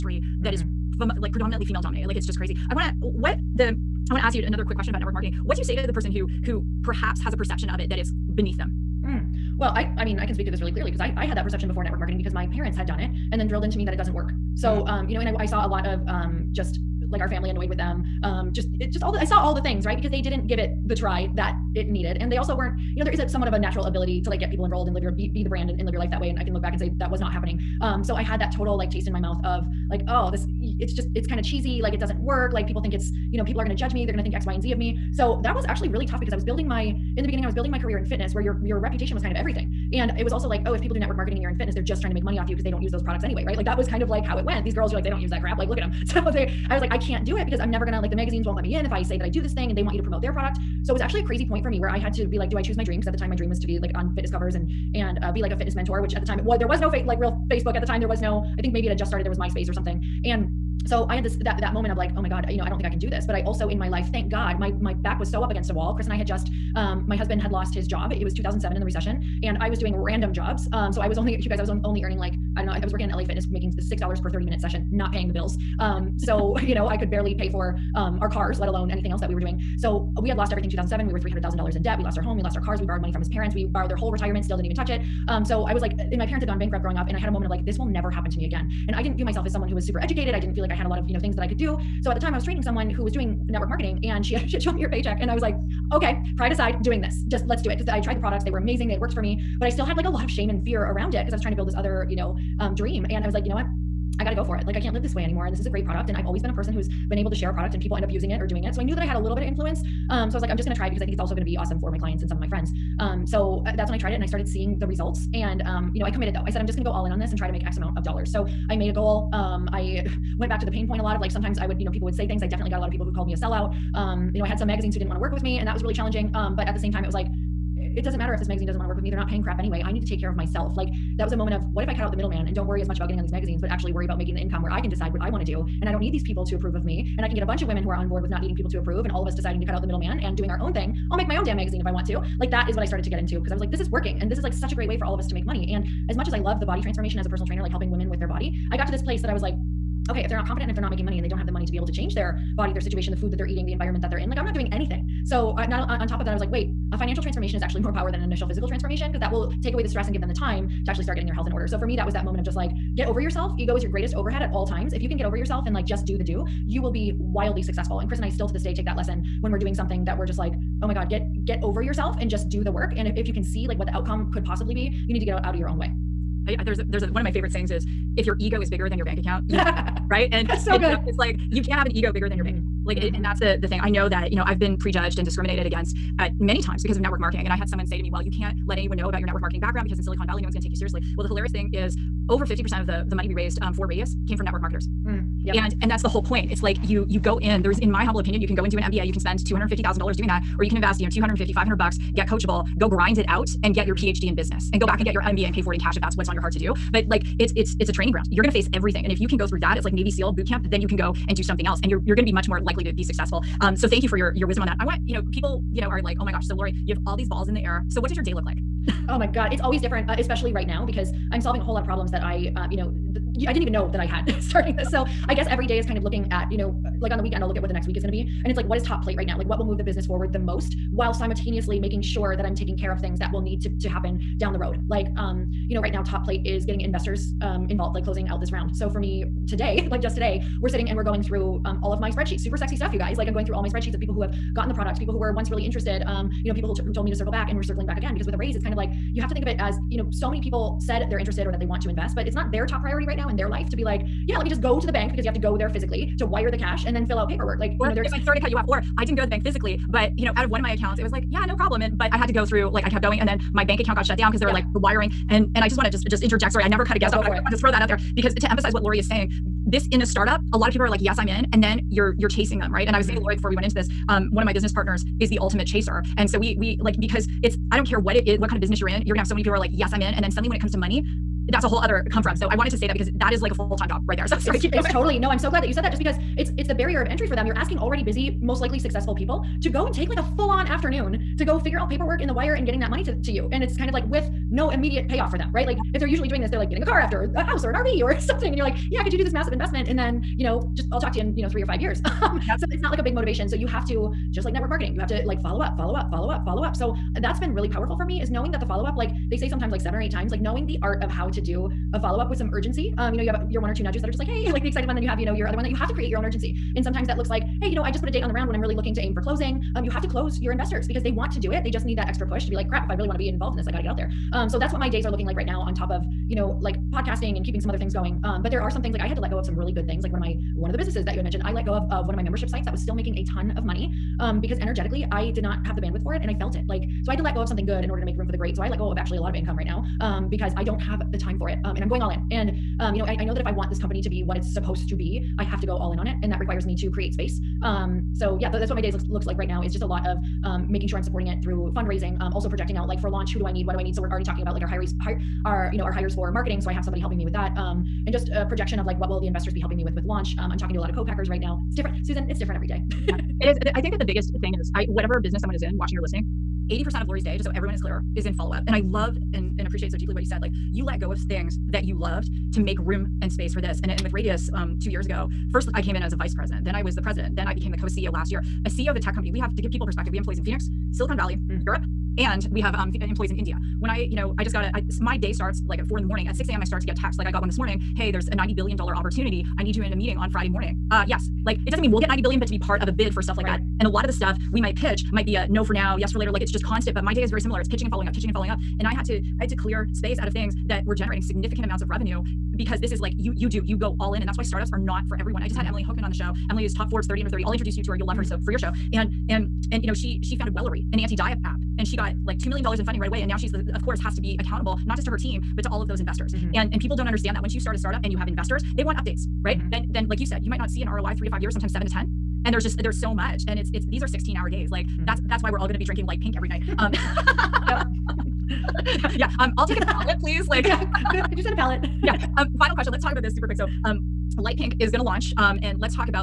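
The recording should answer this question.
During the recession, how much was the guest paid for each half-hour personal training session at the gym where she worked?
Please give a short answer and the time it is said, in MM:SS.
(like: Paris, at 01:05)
$6, at 01:13.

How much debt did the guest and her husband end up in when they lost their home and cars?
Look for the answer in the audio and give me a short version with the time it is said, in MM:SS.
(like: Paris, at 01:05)
$300000, at 01:21.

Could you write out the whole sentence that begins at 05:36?
Like, so I had to let go of something good in order to make room for the great.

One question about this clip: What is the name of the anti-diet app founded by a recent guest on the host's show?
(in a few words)
Wellory.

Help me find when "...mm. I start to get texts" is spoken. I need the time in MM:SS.
06:26.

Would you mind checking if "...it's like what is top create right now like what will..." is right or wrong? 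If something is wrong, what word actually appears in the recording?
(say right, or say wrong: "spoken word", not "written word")
wrong: "plate", not "create".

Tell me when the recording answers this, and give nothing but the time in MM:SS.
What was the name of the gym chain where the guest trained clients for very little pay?
01:13.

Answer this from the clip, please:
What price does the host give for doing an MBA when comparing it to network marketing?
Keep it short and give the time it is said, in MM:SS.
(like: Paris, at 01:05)
$250,000, at 03:19.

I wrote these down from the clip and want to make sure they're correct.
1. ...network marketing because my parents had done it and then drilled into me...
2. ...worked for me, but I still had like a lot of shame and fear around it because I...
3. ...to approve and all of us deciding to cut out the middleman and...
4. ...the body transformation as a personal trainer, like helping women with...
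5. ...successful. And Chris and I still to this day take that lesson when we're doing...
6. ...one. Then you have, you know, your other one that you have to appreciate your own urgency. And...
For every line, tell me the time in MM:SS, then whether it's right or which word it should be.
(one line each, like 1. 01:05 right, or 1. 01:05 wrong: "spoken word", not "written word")
1. 00:11 right
2. 01:38 right
3. 02:18 right
4. 02:26 right
5. 02:47 right
6. 05:14 wrong: "create", not "appreciate".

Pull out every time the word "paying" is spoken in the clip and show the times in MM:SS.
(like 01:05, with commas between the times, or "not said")
01:15, 02:09.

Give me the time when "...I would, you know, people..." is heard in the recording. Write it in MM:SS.
02:01.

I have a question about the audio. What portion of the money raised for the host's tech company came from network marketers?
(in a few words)
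over 50%.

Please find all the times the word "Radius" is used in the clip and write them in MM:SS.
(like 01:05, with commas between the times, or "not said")
03:13, 06:14.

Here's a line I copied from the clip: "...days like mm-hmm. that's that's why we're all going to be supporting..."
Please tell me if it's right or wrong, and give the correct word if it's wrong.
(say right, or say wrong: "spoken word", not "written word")
wrong: "drinking", not "supporting".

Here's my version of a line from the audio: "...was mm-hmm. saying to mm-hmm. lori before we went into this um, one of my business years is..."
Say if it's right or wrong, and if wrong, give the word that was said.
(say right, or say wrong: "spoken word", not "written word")
wrong: "partners", not "years".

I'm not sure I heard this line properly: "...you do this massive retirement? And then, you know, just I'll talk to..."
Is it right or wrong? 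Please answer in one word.
wrong.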